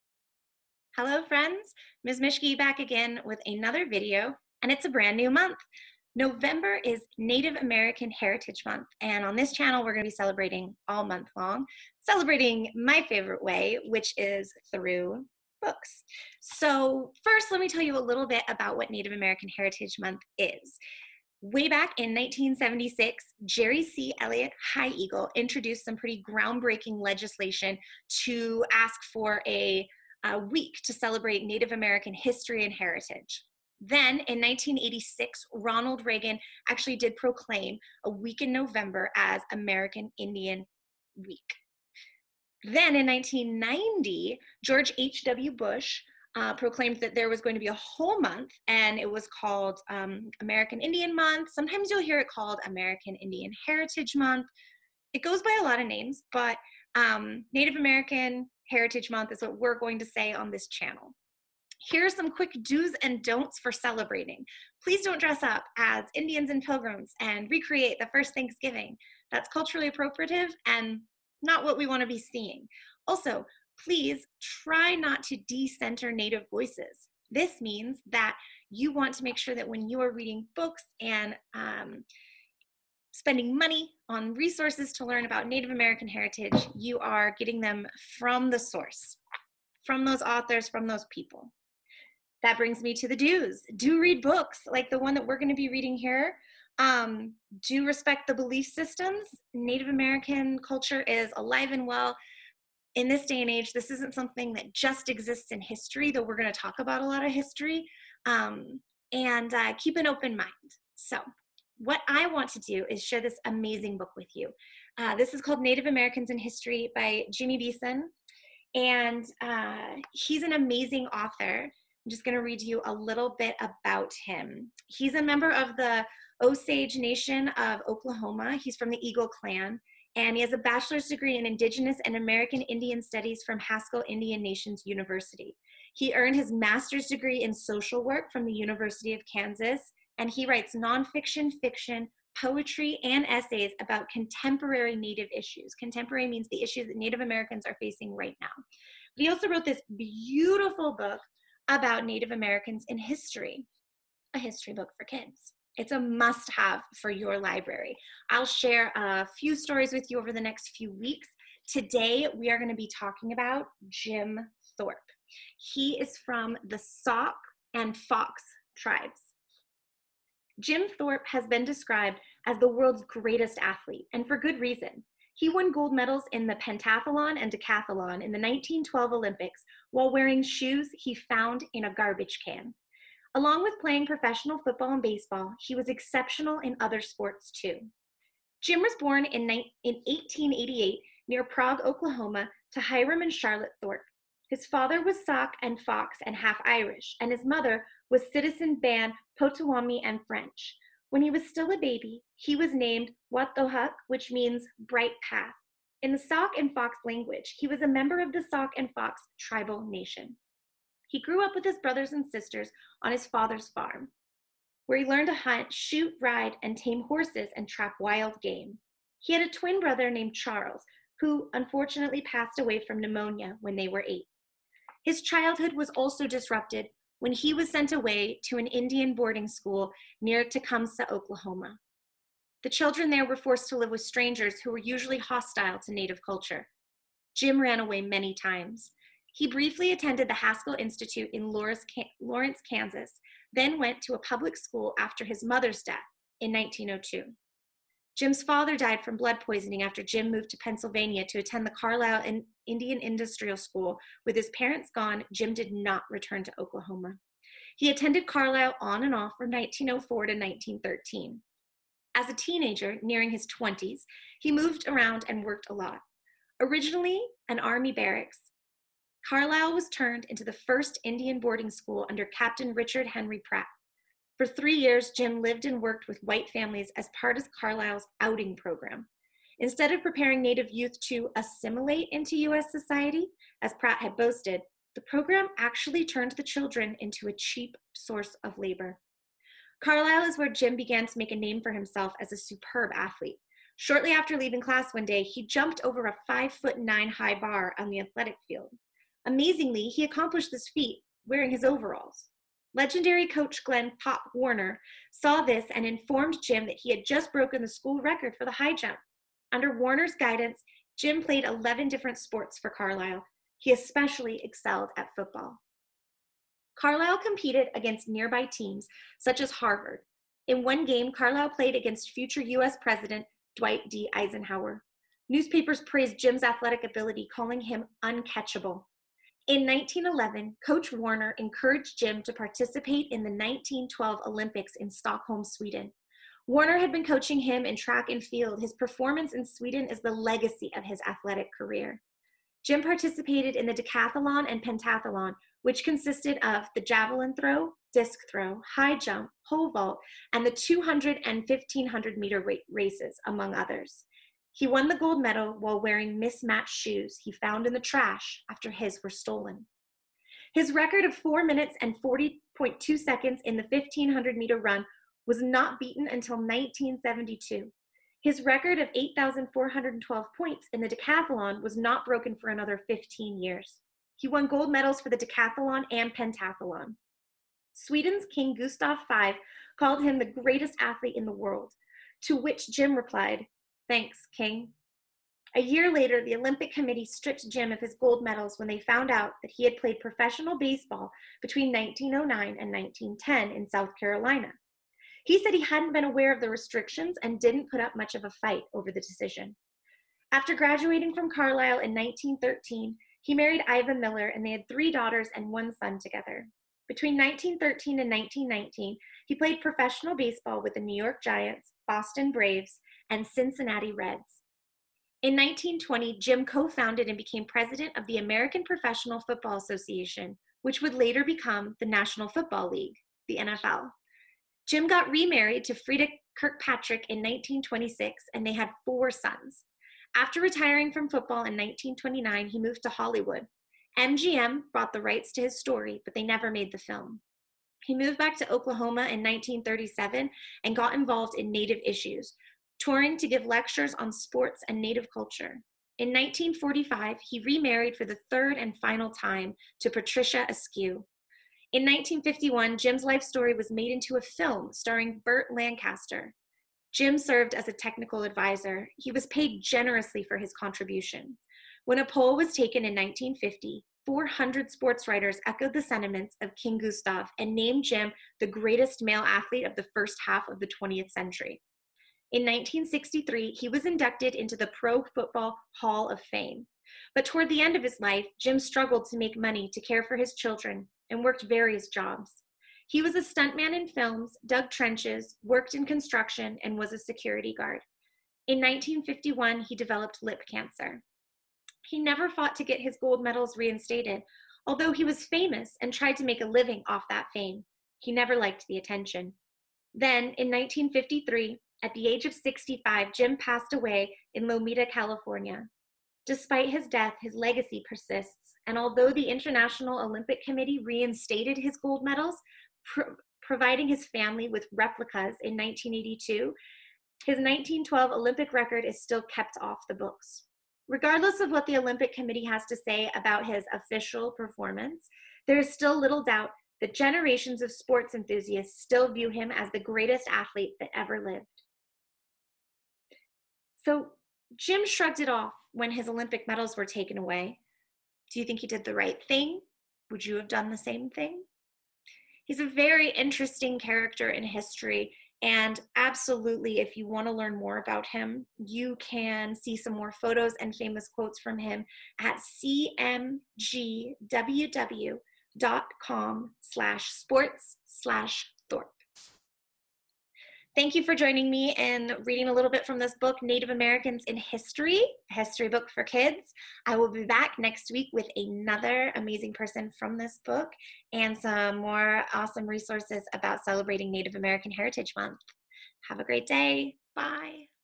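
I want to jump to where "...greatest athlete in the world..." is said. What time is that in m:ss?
6:20.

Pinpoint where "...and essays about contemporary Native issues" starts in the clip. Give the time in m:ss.
2:23.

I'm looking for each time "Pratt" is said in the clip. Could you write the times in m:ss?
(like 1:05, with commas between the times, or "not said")
4:33, 4:43.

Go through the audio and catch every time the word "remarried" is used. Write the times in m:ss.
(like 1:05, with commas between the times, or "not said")
7:05, 7:27.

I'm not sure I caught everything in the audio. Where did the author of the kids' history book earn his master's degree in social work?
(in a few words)
University of Kansas.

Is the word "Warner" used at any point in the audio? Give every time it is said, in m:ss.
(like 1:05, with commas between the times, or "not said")
5:04, 5:09, 5:30, 5:36.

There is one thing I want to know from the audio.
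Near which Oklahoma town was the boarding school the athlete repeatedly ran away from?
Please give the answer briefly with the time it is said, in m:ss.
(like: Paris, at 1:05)
Tecumseh, at 3:50.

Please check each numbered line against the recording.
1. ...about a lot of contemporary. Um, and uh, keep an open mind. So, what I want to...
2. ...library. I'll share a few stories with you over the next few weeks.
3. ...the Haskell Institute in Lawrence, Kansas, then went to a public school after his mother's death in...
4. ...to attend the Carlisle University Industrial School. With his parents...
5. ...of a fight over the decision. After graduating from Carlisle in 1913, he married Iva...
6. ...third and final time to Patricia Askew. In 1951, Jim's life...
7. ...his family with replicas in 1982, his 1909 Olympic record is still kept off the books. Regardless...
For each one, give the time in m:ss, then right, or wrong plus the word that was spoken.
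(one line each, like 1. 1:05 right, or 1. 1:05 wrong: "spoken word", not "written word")
1. 1:46 wrong: "history", not "contemporary"
2. 2:37 right
3. 4:00 right
4. 4:11 wrong: "Indian", not "University"
5. 6:38 right
6. 7:28 right
7. 8:33 wrong: "1912", not "1909".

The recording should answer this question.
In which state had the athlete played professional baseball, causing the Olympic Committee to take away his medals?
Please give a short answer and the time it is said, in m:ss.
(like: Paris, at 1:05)
South Carolina, at 6:33.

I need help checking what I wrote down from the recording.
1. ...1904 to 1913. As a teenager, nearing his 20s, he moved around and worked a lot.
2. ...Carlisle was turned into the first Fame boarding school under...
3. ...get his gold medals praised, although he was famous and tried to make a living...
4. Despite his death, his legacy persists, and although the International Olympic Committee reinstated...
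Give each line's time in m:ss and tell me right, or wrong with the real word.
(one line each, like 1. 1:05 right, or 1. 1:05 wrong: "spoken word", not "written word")
1. 4:19 right
2. 4:29 wrong: "Indian", not "Fame"
3. 8:12 wrong: "reinstated", not "praised"
4. 8:26 right.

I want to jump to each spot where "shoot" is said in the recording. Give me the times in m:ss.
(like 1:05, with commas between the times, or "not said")
3:35.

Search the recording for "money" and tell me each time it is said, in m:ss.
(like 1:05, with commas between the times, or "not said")
1:23, 7:59.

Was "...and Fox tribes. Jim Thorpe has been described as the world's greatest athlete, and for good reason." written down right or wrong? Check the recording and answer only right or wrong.
right.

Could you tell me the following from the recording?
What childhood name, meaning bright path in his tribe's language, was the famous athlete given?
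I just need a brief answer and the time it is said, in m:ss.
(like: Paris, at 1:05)
Watohuk, at 3:23.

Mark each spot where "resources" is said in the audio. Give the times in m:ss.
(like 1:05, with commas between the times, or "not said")
1:24, 9:32.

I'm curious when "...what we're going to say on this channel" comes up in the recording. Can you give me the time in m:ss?
0:59.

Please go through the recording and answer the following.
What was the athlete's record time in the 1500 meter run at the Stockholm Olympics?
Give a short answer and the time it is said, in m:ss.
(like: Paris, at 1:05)
4 minutes 40.2 seconds, at 6:01.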